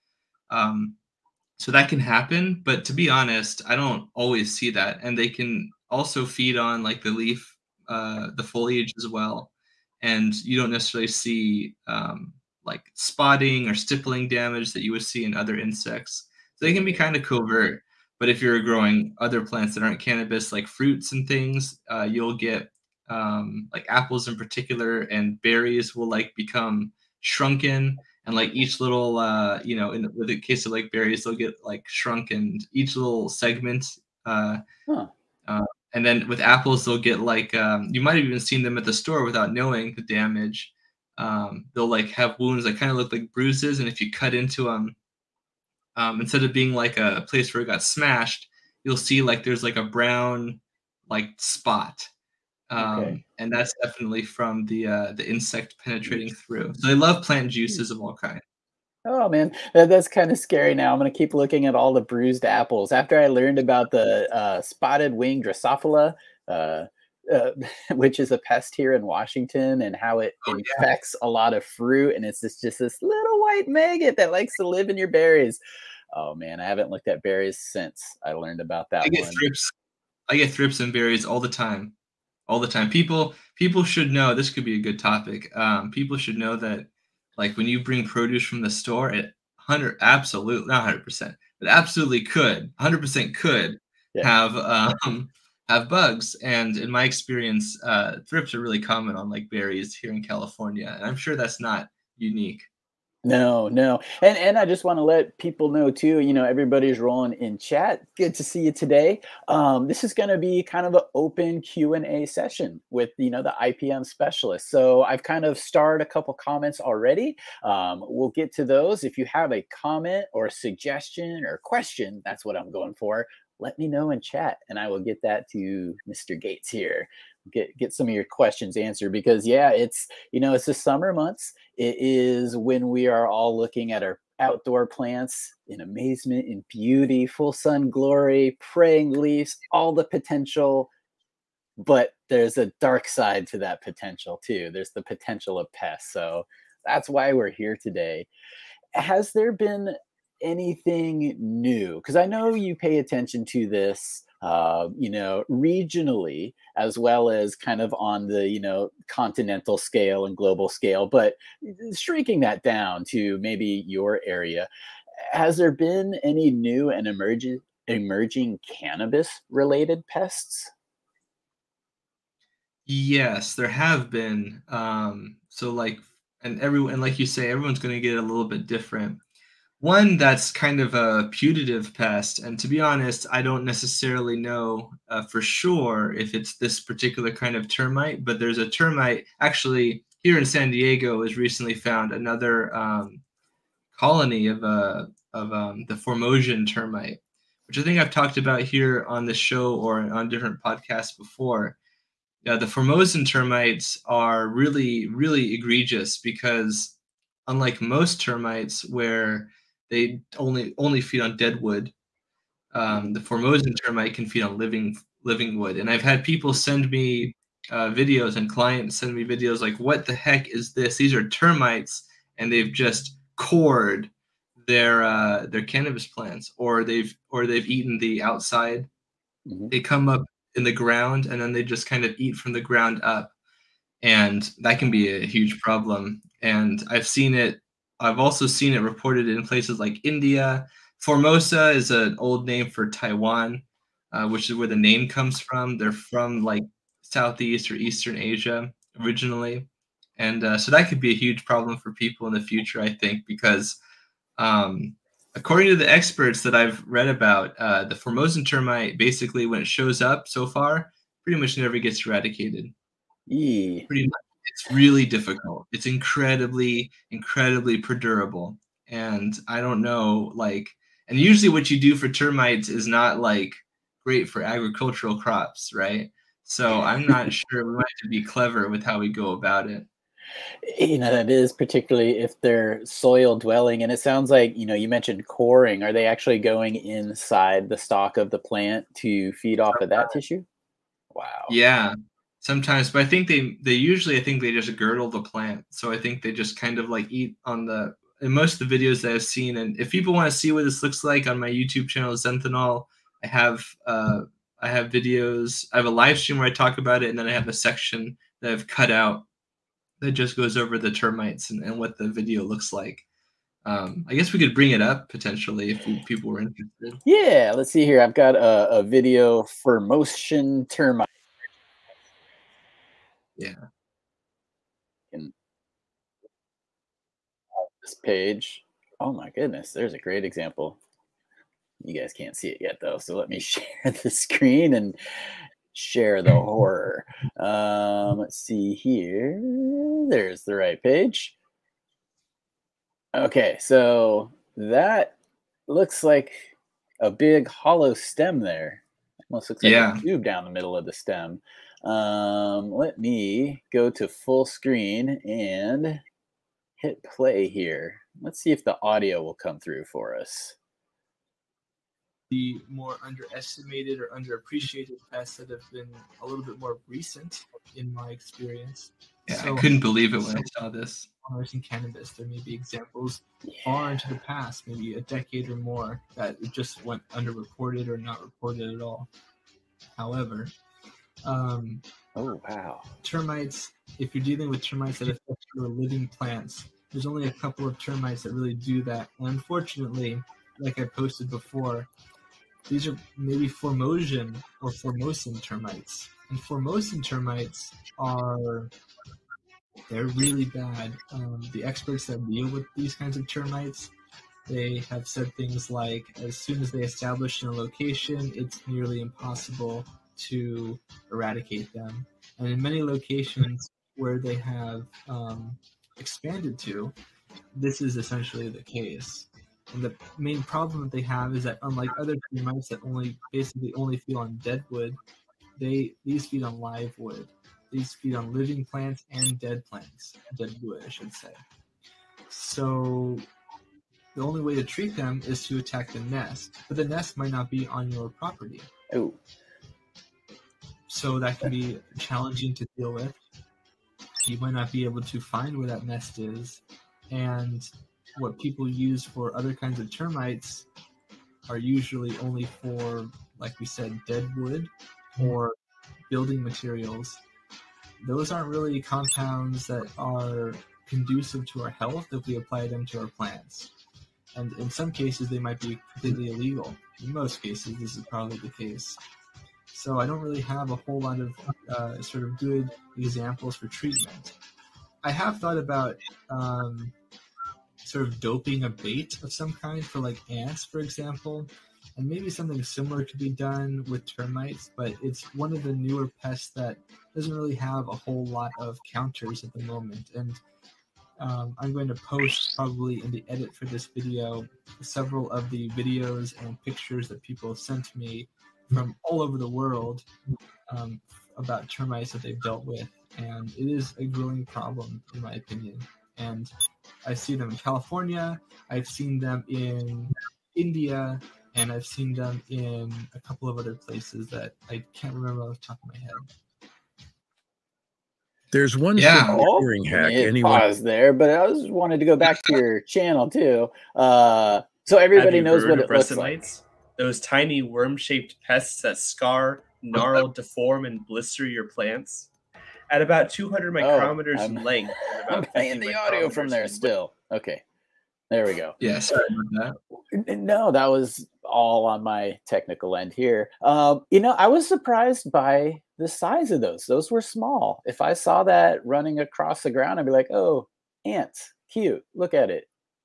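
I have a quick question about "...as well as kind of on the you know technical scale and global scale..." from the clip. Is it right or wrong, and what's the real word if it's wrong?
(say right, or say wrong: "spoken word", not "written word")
wrong: "continental", not "technical".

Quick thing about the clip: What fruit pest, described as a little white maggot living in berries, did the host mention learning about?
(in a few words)
Spotted wing Drosophila.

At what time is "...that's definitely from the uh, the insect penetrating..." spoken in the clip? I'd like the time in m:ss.
0:53.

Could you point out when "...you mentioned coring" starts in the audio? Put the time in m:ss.
4:44.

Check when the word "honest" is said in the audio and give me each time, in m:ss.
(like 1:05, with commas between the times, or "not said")
0:03, 3:02.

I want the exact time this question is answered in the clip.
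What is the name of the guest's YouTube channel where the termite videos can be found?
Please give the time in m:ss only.
5:02.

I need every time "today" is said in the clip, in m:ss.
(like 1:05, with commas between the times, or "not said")
1:48, 2:27.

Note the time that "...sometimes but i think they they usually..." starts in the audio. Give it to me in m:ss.
4:52.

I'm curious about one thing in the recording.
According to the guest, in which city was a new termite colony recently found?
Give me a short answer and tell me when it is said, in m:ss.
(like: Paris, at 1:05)
San Diego, at 3:10.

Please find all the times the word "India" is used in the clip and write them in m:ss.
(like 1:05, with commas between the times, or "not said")
4:00, 8:30.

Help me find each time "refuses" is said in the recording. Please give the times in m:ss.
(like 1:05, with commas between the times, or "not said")
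not said.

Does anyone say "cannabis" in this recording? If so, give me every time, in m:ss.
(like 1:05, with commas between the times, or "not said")
0:20, 2:48, 3:45, 6:11.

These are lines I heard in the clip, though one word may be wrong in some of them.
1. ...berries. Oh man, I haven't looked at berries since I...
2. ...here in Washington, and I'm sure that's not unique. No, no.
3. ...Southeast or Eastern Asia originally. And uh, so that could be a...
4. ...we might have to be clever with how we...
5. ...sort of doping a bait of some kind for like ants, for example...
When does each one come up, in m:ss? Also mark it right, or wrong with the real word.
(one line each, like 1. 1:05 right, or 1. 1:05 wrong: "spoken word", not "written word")
1. 1:15 right
2. 1:39 wrong: "California", not "Washington"
3. 4:07 right
4. 4:37 right
5. 7:57 right.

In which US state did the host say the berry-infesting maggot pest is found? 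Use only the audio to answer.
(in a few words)
Washington.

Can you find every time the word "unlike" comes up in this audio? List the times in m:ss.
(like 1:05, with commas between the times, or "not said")
3:27, 7:01.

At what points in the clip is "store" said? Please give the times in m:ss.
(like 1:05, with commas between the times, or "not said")
0:38, 1:28.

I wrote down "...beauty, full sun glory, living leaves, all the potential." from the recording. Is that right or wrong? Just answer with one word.
wrong.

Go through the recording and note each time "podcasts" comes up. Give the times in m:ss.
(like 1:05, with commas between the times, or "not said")
3:20.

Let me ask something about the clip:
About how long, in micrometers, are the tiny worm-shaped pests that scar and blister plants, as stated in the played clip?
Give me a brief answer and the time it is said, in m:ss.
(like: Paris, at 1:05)
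200 micrometers, at 8:53.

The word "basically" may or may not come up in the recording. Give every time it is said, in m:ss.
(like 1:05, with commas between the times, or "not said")
4:18, 7:03.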